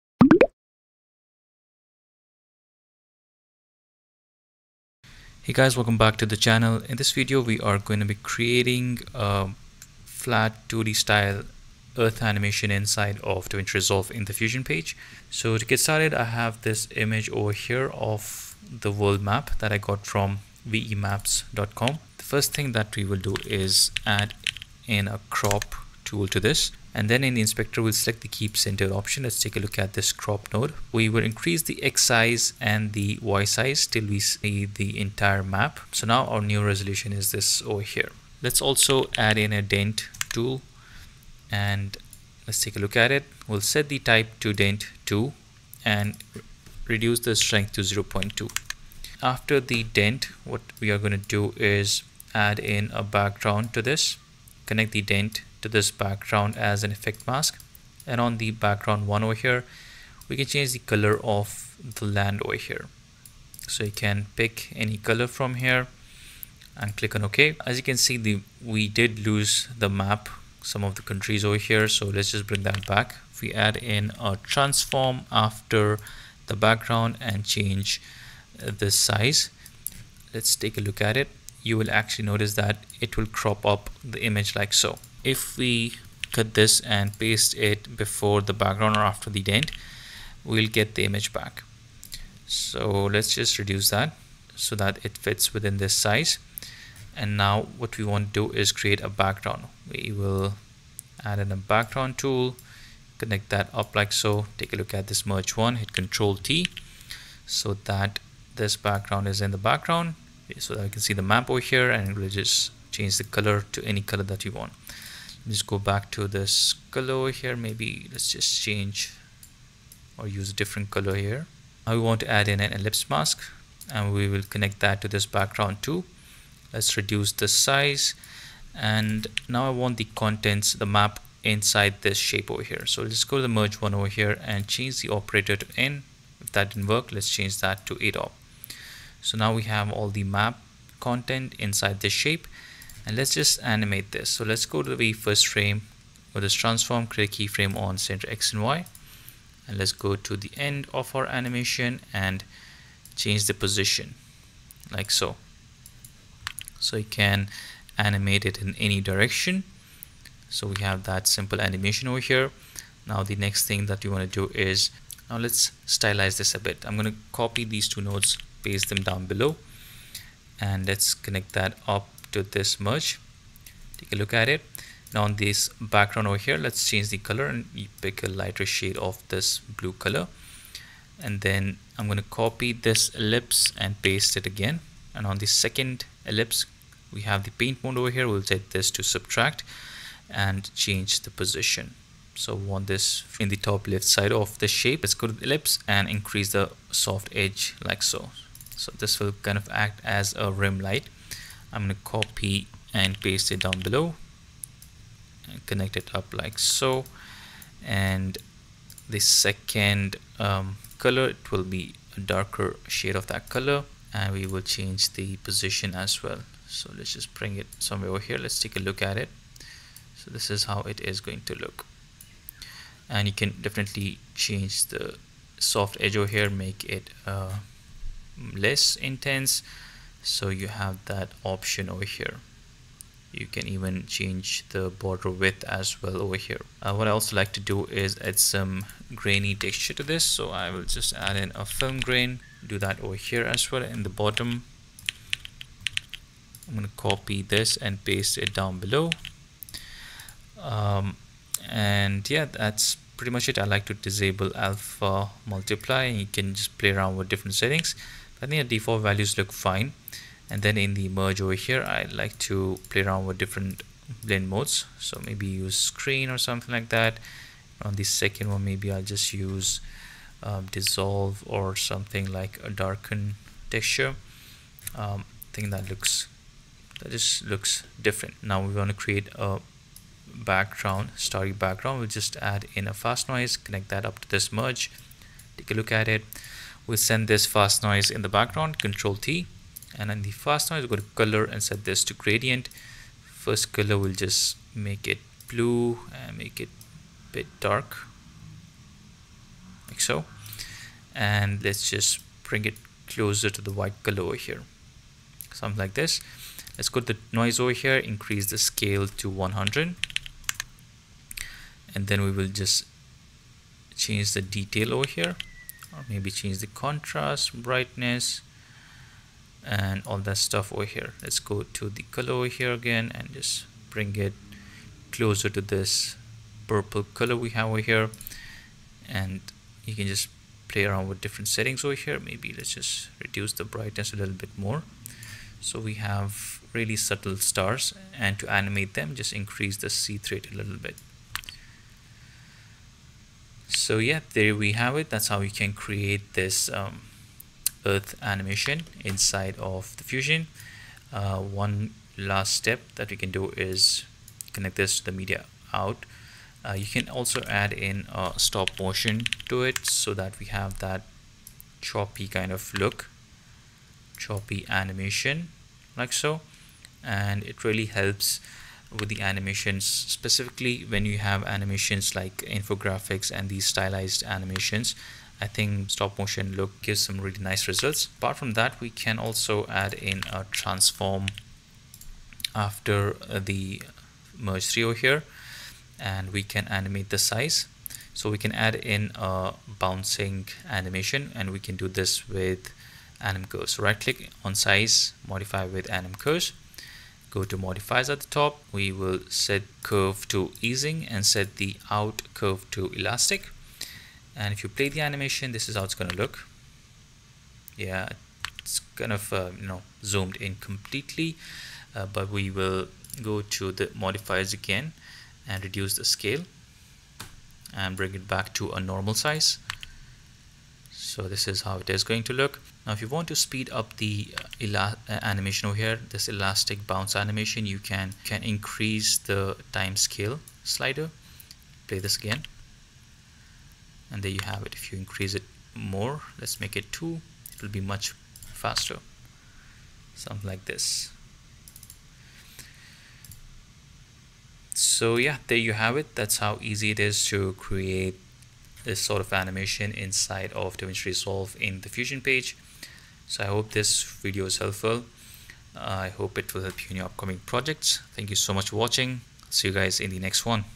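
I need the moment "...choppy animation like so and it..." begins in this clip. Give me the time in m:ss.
6:04.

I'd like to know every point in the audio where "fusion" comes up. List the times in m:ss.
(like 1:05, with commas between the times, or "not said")
0:14, 5:50, 7:31.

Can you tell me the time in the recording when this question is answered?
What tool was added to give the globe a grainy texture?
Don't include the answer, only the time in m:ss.
4:01.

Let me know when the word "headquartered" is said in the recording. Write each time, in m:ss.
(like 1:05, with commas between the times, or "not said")
not said.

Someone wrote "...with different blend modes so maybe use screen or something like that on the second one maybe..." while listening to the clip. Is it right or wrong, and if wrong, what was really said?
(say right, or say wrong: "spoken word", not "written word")
right.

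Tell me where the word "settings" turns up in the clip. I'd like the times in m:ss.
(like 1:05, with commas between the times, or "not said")
4:17, 5:31.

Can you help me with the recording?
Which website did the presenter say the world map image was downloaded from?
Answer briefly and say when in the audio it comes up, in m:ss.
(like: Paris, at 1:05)
vemaps.com, at 0:20.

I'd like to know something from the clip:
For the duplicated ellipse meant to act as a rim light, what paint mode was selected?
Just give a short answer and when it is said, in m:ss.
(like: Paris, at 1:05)
Subtract, at 3:09.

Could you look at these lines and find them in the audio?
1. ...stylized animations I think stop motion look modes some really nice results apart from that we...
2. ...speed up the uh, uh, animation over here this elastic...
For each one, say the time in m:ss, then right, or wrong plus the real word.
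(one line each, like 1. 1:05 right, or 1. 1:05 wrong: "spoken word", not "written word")
1. 6:13 wrong: "gives", not "modes"
2. 7:03 right.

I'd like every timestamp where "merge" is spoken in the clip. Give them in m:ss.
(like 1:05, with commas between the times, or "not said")
1:45, 2:13, 2:52, 4:21, 4:44, 6:24.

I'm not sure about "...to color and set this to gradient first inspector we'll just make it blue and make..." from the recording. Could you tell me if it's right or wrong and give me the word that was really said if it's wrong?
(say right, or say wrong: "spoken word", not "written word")
wrong: "color", not "inspector".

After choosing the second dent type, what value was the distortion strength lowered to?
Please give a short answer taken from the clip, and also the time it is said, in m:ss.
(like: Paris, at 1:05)
0.2, at 0:47.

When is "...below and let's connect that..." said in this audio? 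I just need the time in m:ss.
2:49.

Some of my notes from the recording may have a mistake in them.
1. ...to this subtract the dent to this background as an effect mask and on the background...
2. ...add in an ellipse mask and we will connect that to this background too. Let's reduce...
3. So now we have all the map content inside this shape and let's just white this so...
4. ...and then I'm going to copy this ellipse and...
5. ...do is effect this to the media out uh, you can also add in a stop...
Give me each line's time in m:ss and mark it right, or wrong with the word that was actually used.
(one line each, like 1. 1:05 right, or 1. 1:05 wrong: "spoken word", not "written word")
1. 0:53 wrong: "connect", not "subtract"
2. 2:02 right
3. 2:19 wrong: "animate", not "white"
4. 3:01 right
5. 5:53 wrong: "connect", not "effect".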